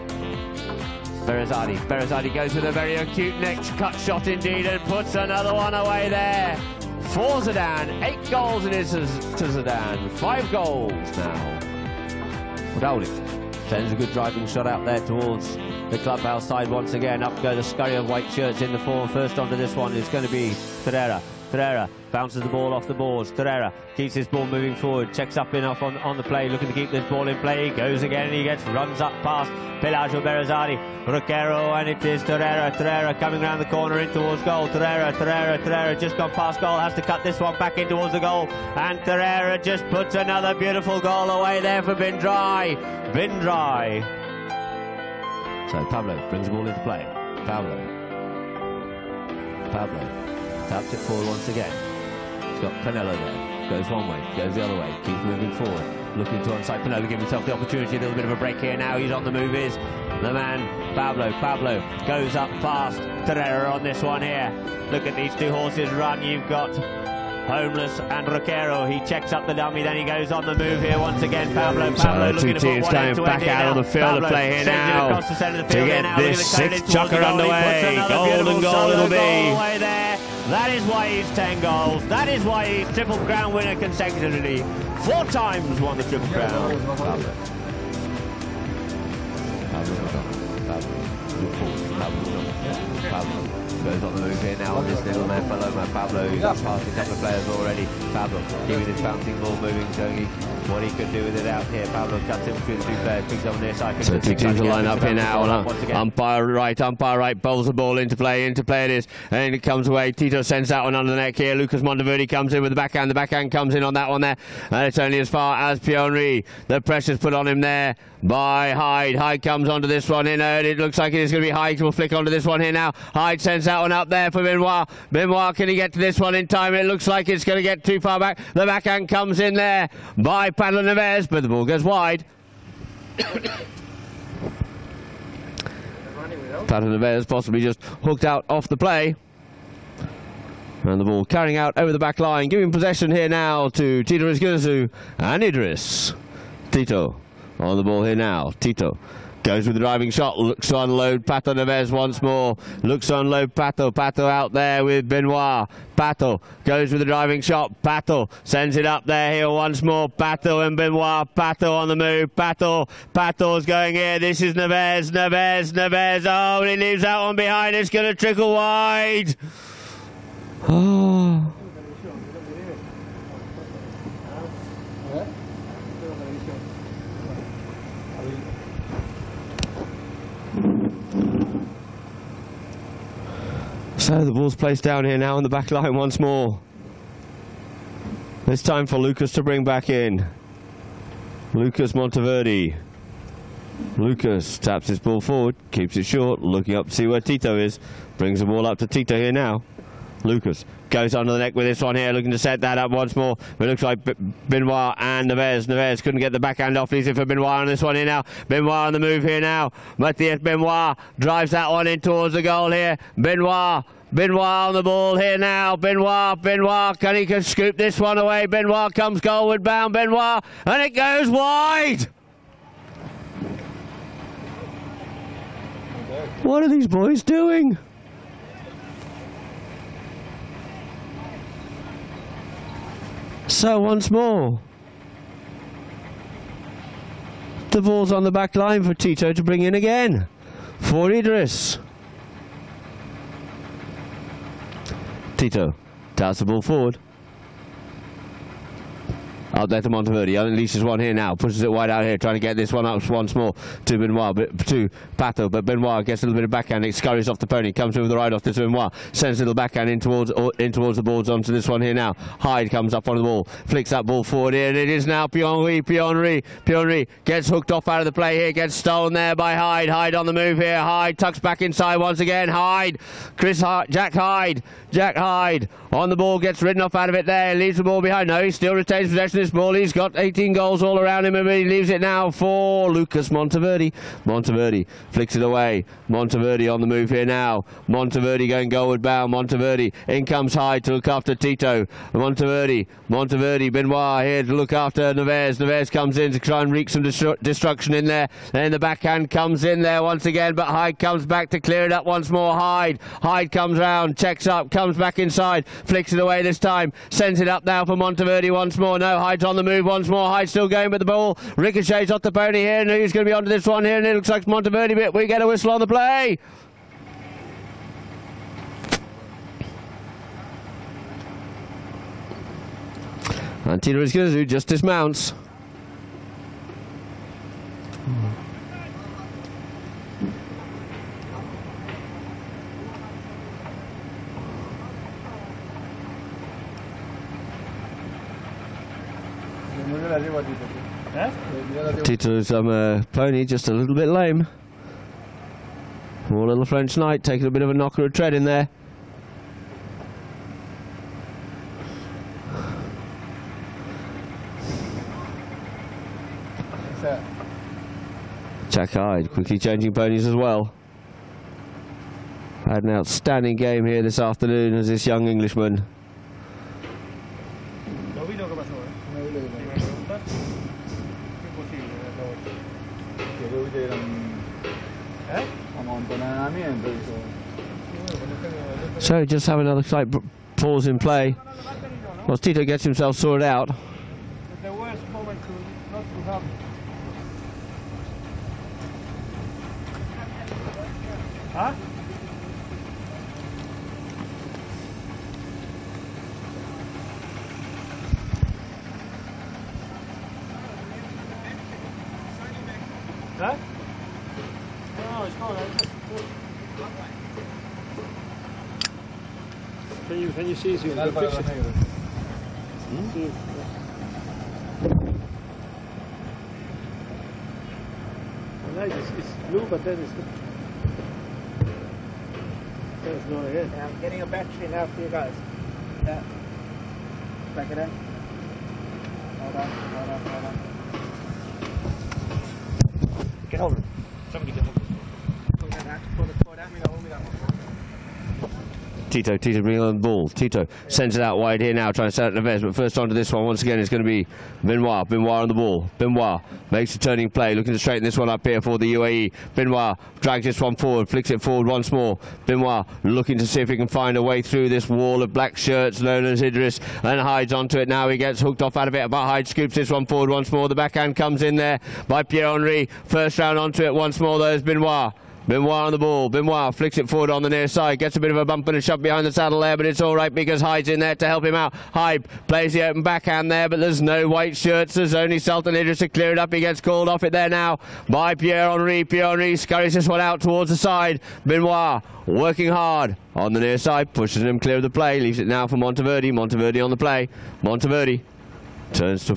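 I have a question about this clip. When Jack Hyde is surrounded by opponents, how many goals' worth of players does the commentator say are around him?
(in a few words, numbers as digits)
18.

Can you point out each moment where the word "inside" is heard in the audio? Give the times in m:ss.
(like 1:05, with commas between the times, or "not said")
4:31, 5:05.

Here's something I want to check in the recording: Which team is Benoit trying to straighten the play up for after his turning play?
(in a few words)
UAE.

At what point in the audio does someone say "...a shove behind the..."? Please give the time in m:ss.
7:48.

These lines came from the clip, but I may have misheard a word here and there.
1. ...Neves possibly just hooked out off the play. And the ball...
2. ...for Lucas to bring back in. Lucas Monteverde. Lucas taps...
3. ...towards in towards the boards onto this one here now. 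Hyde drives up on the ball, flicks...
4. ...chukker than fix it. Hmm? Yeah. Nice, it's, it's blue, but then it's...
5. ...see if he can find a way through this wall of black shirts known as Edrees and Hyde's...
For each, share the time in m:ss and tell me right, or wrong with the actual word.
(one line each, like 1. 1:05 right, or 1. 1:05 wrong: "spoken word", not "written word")
1. 2:16 right
2. 3:08 right
3. 4:19 wrong: "comes", not "drives"
4. 6:50 wrong: "easier", not "chukker"
5. 7:33 right.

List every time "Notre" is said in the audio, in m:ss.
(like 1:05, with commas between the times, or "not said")
not said.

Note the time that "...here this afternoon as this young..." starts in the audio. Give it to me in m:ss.
6:03.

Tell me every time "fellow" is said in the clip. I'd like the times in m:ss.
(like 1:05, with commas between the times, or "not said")
1:35.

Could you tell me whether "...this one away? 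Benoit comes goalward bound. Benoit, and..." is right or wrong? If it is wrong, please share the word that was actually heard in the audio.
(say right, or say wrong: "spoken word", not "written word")
right.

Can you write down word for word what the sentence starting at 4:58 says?
Then the backhand comes in there once again, but Hyde comes back to clear it up once more.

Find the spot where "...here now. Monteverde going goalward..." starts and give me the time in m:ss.
4:47.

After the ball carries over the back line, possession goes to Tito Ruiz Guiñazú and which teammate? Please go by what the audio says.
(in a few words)
Idris.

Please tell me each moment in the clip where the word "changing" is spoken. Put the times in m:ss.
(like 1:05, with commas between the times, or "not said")
5:59.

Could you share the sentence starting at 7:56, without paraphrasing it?
He gets called off it there now by Pierre Henri.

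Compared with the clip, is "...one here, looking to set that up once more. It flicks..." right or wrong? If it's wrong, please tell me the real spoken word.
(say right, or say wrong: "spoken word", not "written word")
wrong: "looks", not "flicks".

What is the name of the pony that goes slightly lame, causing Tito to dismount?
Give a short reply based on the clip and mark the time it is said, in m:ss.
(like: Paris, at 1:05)
French Knight, at 5:46.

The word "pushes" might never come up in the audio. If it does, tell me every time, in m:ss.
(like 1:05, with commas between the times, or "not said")
4:11, 8:04.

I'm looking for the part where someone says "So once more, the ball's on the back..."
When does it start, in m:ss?
3:53.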